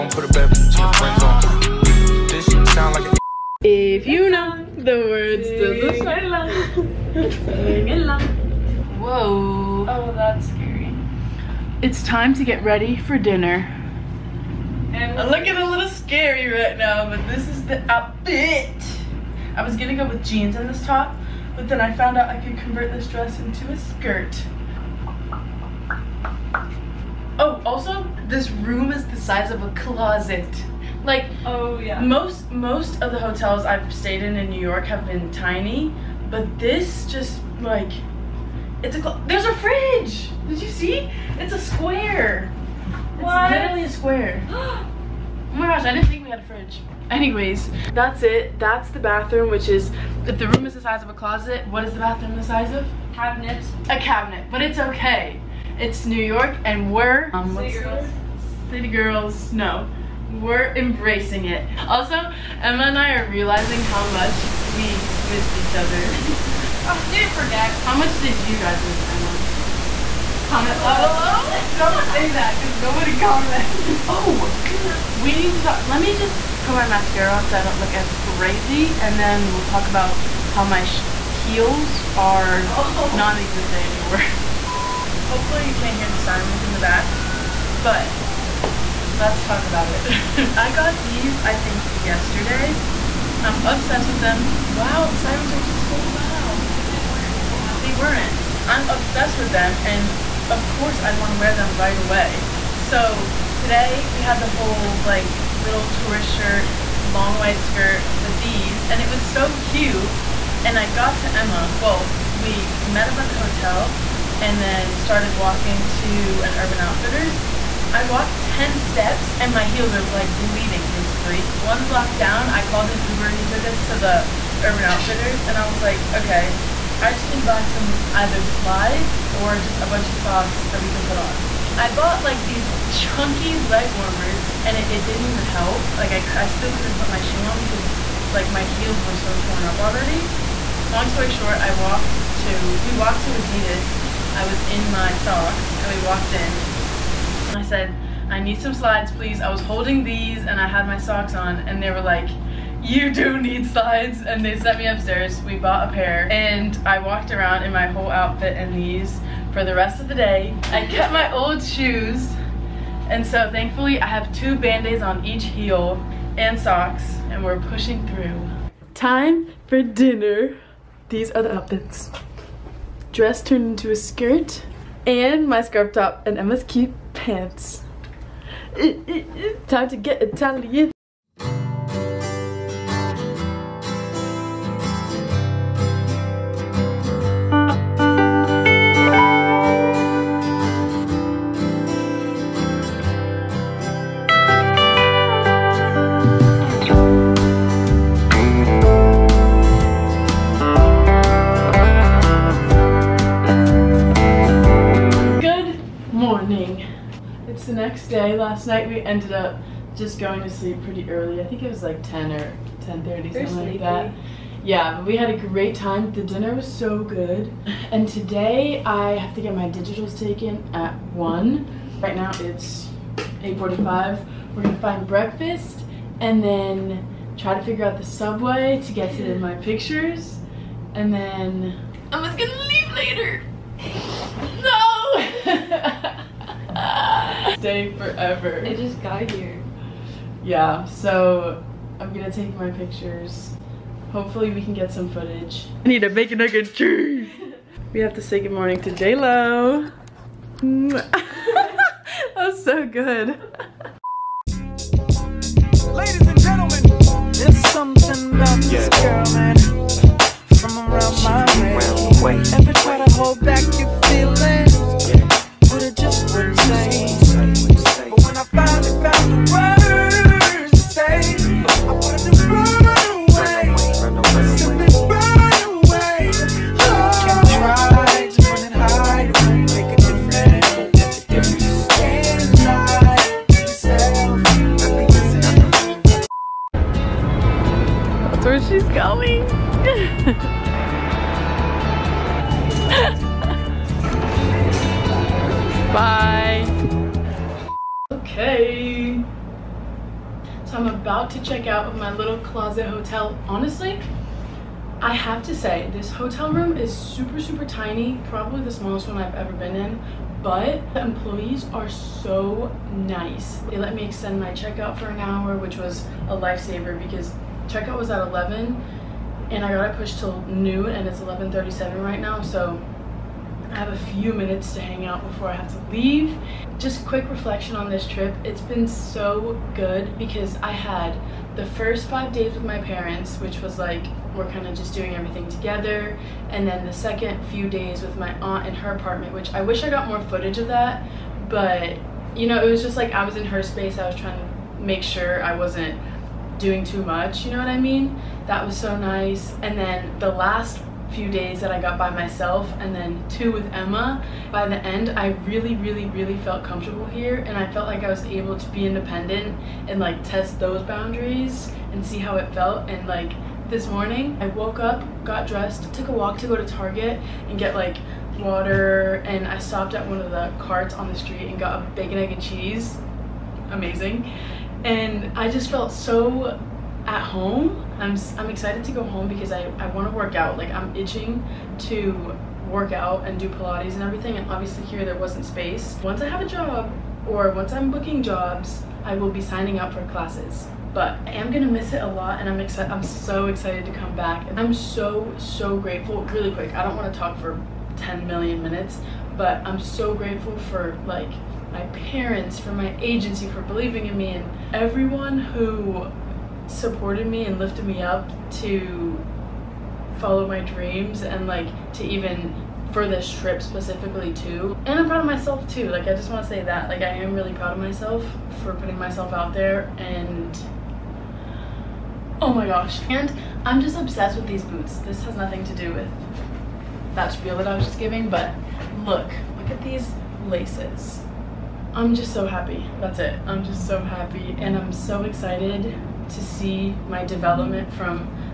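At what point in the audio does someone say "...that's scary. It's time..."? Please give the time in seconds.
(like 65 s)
10 s.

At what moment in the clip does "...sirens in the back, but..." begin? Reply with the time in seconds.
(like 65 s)
86 s.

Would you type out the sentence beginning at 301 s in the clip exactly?
about to check out of my little closet hotel.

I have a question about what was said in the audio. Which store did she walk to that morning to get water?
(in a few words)
Target.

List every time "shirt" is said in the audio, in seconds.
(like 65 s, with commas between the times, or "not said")
106 s.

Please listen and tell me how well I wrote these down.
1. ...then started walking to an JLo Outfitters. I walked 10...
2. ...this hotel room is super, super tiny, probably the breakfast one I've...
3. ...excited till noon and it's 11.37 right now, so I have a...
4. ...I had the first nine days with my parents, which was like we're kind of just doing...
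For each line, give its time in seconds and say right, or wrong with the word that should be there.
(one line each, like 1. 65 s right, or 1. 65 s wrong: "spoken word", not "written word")
1. 114 s wrong: "Urban", not "JLo"
2. 305 s wrong: "smallest", not "breakfast"
3. 319 s wrong: "pushed", not "excited"
4. 330 s wrong: "five", not "nine".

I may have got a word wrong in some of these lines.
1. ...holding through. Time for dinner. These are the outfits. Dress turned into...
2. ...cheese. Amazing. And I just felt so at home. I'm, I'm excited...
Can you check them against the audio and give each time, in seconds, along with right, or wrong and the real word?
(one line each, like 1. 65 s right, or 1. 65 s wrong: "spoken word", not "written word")
1. 167 s wrong: "pushing", not "holding"
2. 372 s right.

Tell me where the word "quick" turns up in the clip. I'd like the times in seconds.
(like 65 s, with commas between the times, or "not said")
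327 s, 396 s.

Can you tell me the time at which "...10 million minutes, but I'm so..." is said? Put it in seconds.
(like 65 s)
397 s.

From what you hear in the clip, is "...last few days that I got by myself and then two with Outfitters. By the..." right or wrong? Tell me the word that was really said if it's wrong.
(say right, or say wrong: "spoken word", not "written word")
wrong: "Emma", not "Outfitters".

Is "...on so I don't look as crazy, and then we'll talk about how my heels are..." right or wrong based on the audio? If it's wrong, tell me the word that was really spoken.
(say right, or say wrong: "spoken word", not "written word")
right.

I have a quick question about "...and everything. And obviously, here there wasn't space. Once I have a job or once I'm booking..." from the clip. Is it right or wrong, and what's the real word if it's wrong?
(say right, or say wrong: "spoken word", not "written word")
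right.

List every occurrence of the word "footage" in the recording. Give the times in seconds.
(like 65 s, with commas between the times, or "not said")
245 s, 340 s.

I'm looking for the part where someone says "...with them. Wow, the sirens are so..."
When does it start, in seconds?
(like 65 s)
94 s.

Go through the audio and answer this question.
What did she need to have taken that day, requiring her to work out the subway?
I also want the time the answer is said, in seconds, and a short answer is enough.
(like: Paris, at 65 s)
Digitals, at 219 s.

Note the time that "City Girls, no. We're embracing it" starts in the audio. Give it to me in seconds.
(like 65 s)
58 s.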